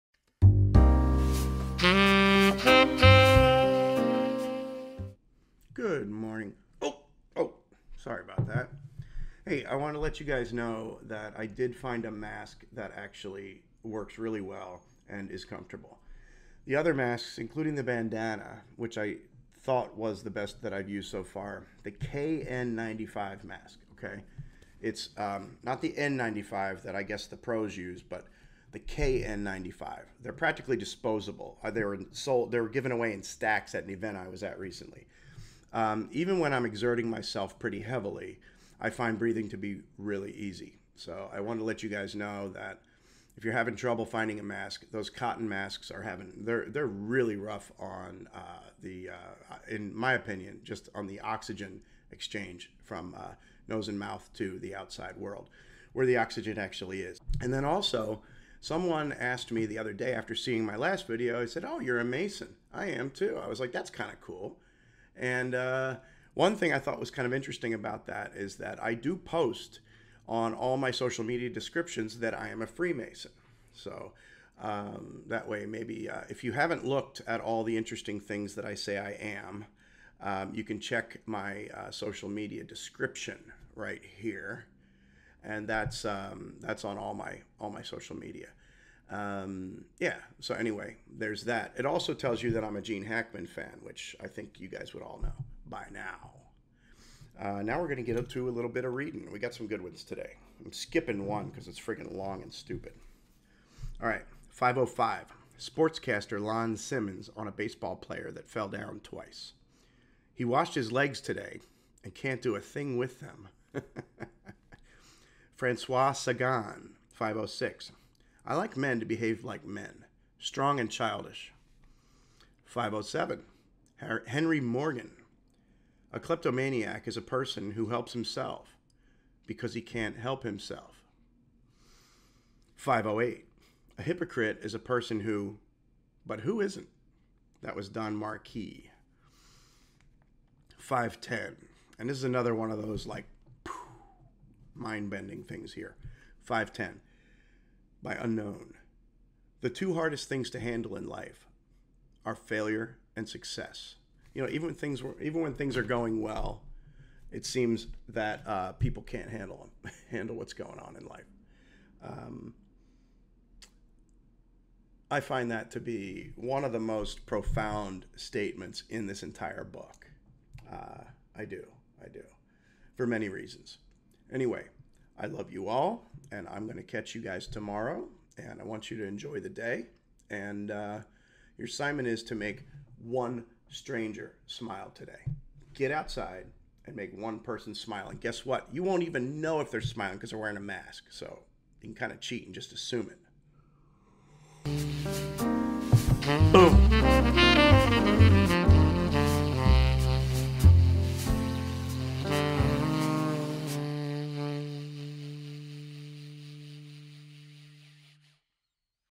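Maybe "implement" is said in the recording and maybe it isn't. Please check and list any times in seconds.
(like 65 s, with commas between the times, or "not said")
not said.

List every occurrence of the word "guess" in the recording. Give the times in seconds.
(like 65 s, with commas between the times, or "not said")
27 s, 188 s.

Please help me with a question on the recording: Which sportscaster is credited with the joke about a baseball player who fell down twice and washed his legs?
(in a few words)
Lon Simmons.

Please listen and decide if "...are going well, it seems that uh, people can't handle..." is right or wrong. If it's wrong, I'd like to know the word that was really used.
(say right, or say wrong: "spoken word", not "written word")
right.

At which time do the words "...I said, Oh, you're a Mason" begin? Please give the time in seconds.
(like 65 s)
61 s.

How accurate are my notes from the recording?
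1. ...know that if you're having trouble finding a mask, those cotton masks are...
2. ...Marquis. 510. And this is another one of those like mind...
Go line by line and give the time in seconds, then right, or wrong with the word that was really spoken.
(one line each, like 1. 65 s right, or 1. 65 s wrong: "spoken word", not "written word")
1. 42 s right
2. 138 s right.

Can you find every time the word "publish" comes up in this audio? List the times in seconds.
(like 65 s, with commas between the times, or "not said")
not said.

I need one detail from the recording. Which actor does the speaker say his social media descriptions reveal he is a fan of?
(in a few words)
Gene Hackman.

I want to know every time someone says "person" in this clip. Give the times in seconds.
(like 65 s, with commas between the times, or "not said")
127 s, 134 s, 187 s.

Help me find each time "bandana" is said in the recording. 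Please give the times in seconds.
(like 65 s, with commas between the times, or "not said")
17 s.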